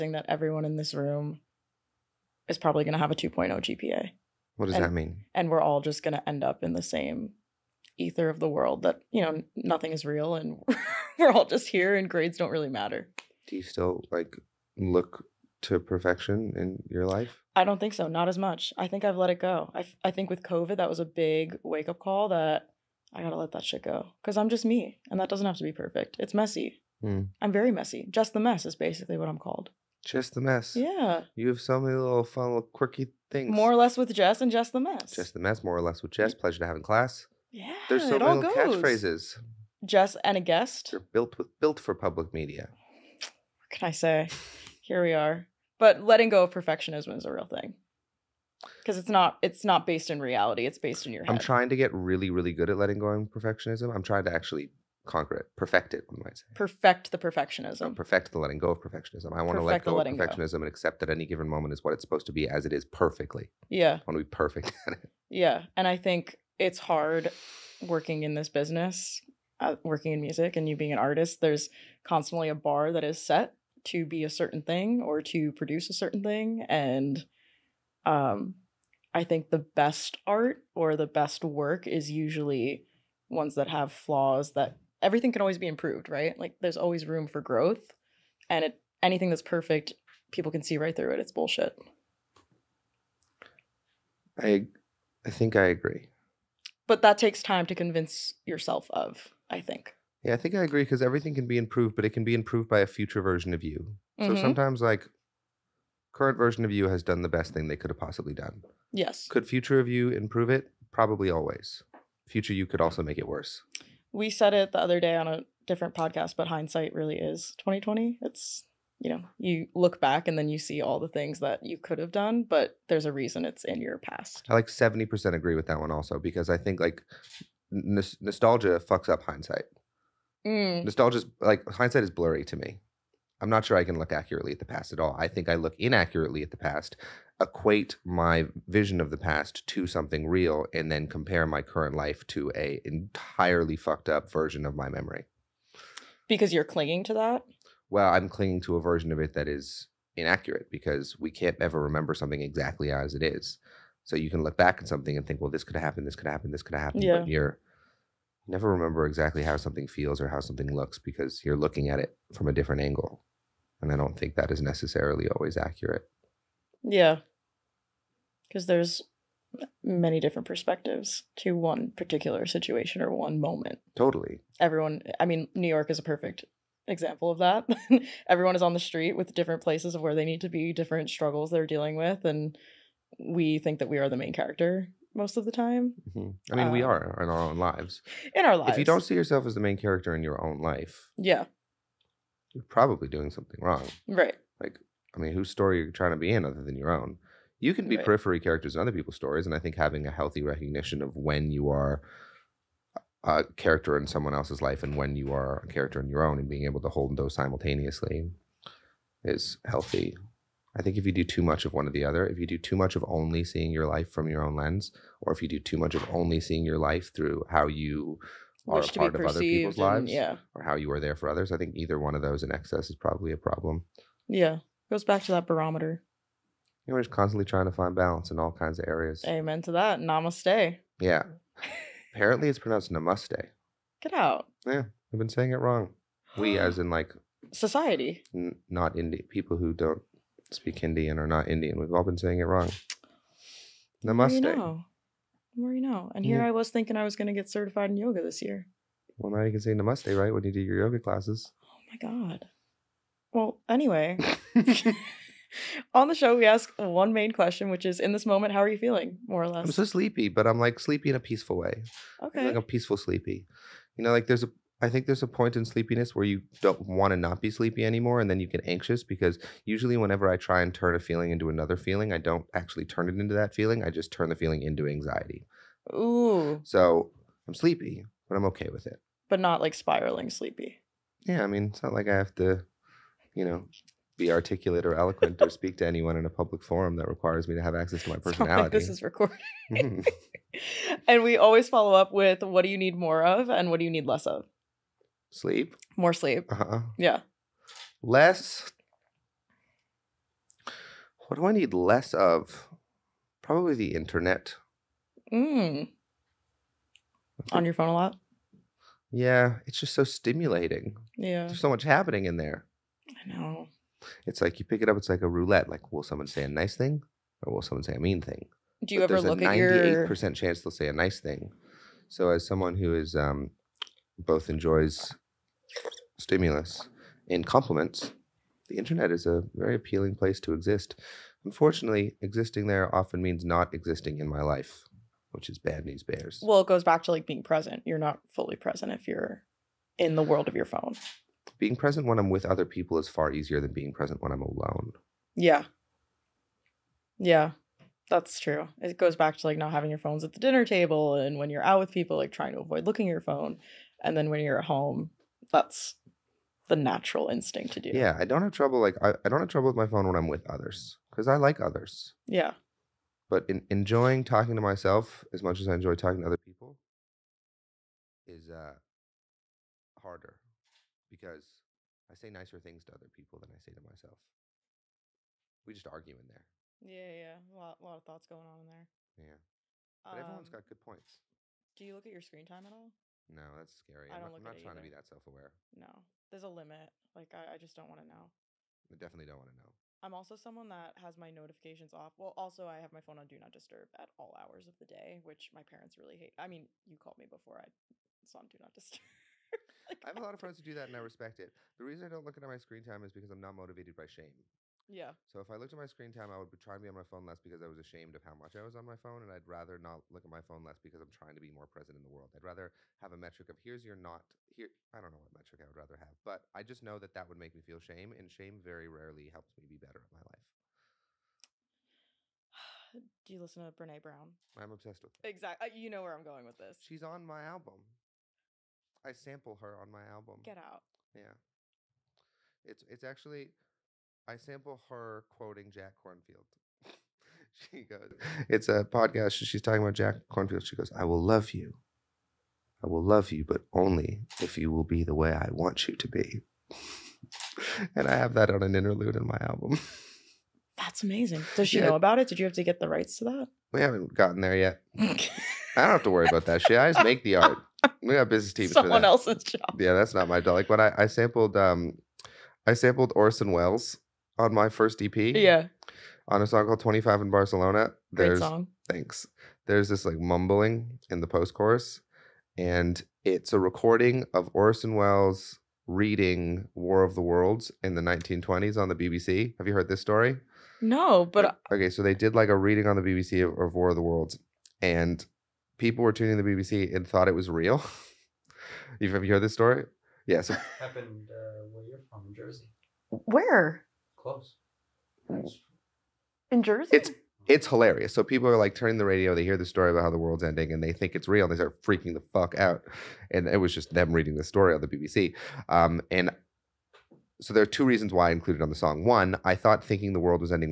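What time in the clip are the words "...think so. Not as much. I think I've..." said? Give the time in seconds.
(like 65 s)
17 s.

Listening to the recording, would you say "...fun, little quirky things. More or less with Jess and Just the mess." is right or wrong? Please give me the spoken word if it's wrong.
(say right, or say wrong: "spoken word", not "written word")
right.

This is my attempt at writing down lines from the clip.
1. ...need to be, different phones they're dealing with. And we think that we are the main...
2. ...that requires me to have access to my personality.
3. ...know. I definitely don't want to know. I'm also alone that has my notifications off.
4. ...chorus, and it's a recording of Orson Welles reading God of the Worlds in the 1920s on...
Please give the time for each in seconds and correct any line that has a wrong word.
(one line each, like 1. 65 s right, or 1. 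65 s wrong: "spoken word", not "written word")
1. 180 s wrong: "struggles", not "phones"
2. 286 s right
3. 388 s wrong: "someone", not "alone"
4. 471 s wrong: "War", not "God".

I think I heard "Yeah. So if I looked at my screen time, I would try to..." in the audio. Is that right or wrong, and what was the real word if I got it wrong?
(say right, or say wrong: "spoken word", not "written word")
right.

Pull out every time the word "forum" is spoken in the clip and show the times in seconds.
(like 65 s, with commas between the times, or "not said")
286 s.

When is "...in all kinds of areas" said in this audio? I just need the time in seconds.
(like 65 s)
228 s.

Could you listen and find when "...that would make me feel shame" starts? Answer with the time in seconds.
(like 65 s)
417 s.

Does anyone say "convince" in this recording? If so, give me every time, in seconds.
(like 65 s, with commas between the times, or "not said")
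97 s.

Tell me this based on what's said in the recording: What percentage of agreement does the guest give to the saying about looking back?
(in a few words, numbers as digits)
70%.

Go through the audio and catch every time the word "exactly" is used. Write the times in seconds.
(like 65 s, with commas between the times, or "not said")
152 s, 159 s, 425 s.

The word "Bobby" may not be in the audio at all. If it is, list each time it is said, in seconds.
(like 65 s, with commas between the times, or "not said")
not said.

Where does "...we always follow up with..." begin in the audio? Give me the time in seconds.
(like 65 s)
291 s.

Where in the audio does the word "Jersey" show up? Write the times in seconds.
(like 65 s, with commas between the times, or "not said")
492 s, 496 s.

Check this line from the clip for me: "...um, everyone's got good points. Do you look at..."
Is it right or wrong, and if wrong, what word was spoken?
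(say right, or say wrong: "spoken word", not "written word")
right.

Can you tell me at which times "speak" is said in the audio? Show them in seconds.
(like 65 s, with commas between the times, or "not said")
240 s, 285 s.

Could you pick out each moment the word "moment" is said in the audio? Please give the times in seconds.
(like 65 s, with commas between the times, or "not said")
61 s, 173 s, 258 s.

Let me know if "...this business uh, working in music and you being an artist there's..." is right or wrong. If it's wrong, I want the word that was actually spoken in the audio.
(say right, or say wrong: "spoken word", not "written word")
right.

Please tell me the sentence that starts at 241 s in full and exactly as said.
We've all been saying it wrong.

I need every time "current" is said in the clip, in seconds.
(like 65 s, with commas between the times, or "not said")
106 s, 141 s.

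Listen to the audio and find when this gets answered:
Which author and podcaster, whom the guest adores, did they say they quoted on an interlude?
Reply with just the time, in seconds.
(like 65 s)
423 s.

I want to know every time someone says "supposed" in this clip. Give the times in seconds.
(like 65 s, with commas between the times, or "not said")
62 s.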